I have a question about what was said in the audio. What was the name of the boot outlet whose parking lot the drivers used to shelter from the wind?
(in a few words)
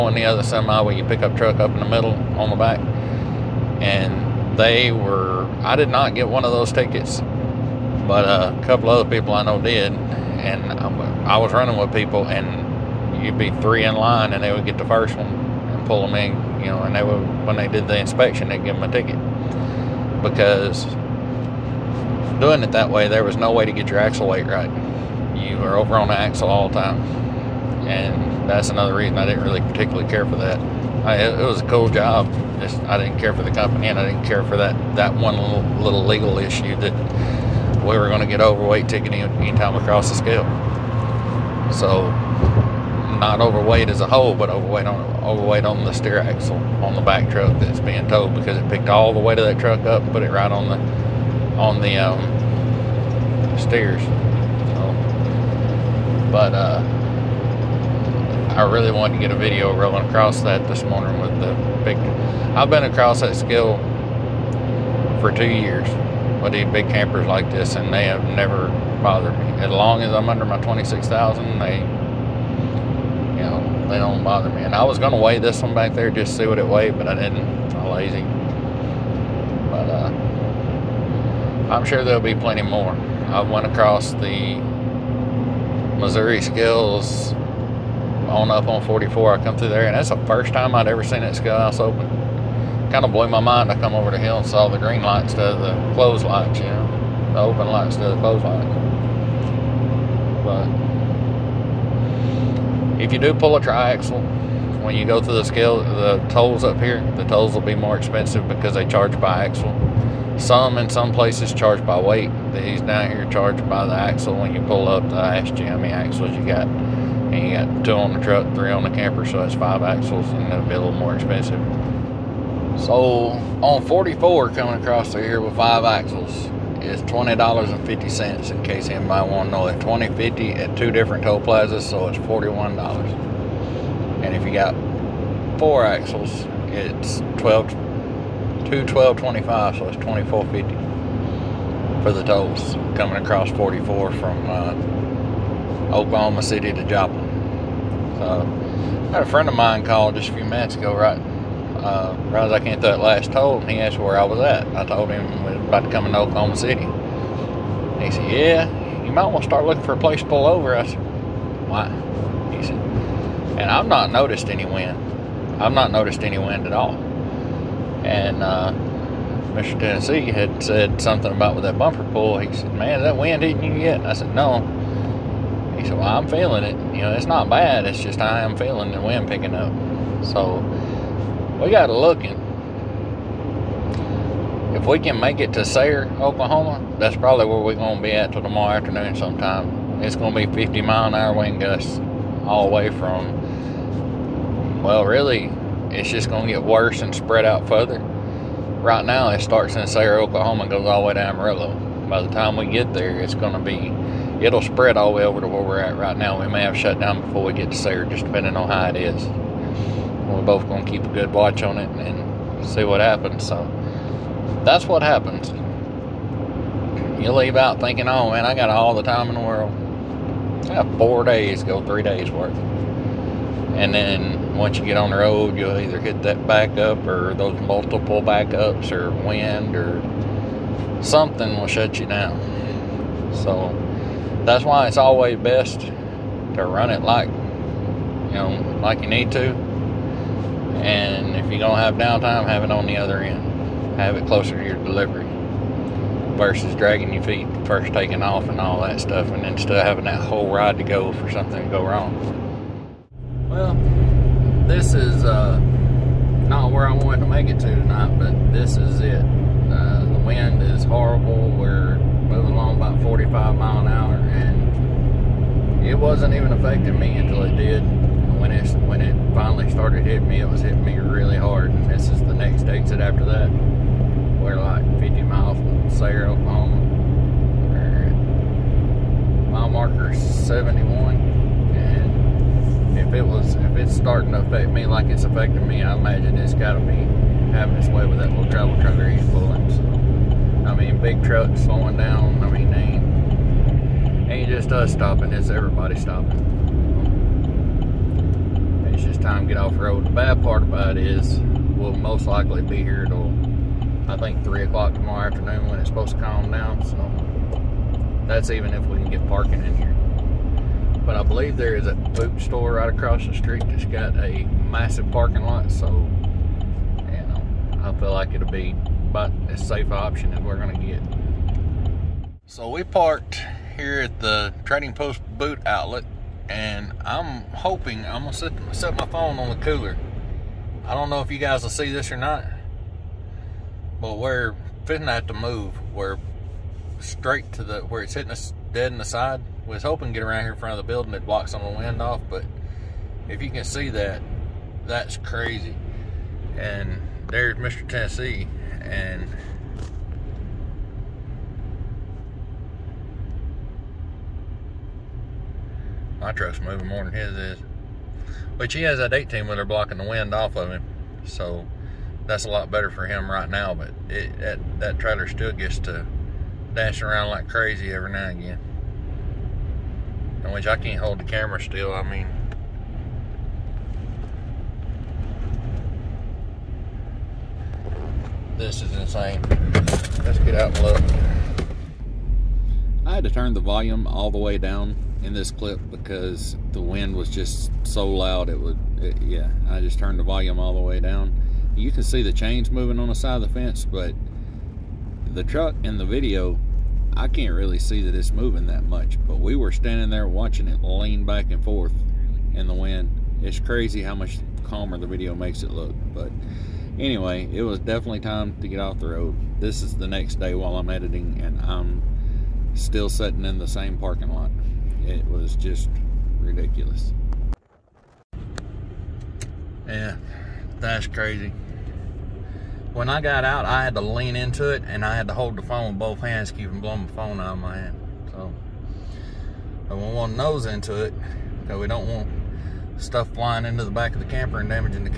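Trading Post.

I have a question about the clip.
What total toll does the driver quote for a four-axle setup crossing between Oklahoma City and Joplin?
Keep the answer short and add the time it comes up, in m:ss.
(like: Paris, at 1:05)
$24.50, at 2:19.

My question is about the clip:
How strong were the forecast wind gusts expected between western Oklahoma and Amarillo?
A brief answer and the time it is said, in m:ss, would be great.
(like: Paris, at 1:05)
50 mph, at 3:10.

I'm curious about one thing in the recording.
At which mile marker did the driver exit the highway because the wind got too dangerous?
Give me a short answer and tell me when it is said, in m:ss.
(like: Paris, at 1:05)
71, at 4:39.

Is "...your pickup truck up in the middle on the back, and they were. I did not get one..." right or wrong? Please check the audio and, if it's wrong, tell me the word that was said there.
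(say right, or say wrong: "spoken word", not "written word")
right.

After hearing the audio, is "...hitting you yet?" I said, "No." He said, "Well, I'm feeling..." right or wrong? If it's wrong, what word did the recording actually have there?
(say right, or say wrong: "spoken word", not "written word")
right.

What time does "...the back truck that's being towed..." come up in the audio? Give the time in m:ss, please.
0:46.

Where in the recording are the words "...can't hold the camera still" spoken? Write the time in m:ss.
6:10.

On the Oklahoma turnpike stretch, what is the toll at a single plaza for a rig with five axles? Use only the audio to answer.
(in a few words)
$20.50.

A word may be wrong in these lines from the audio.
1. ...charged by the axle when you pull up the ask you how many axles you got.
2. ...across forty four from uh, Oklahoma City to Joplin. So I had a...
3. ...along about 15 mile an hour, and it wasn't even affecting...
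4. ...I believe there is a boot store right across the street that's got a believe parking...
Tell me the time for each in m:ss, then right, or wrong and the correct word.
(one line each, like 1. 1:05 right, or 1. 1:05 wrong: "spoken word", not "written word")
1. 1:53 right
2. 2:23 right
3. 4:22 wrong: "45", not "15"
4. 5:11 wrong: "massive", not "believe".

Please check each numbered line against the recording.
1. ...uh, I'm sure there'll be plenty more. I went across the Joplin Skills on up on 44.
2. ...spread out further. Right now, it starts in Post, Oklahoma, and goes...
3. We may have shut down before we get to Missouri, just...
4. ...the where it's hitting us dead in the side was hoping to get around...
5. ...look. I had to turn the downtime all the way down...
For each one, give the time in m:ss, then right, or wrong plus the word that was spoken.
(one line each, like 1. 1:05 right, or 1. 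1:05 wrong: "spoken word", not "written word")
1. 1:19 wrong: "Missouri", not "Joplin"
2. 3:17 wrong: "Sayre", not "Post"
3. 3:26 wrong: "Sayre", not "Missouri"
4. 5:37 right
5. 6:20 wrong: "volume", not "downtime".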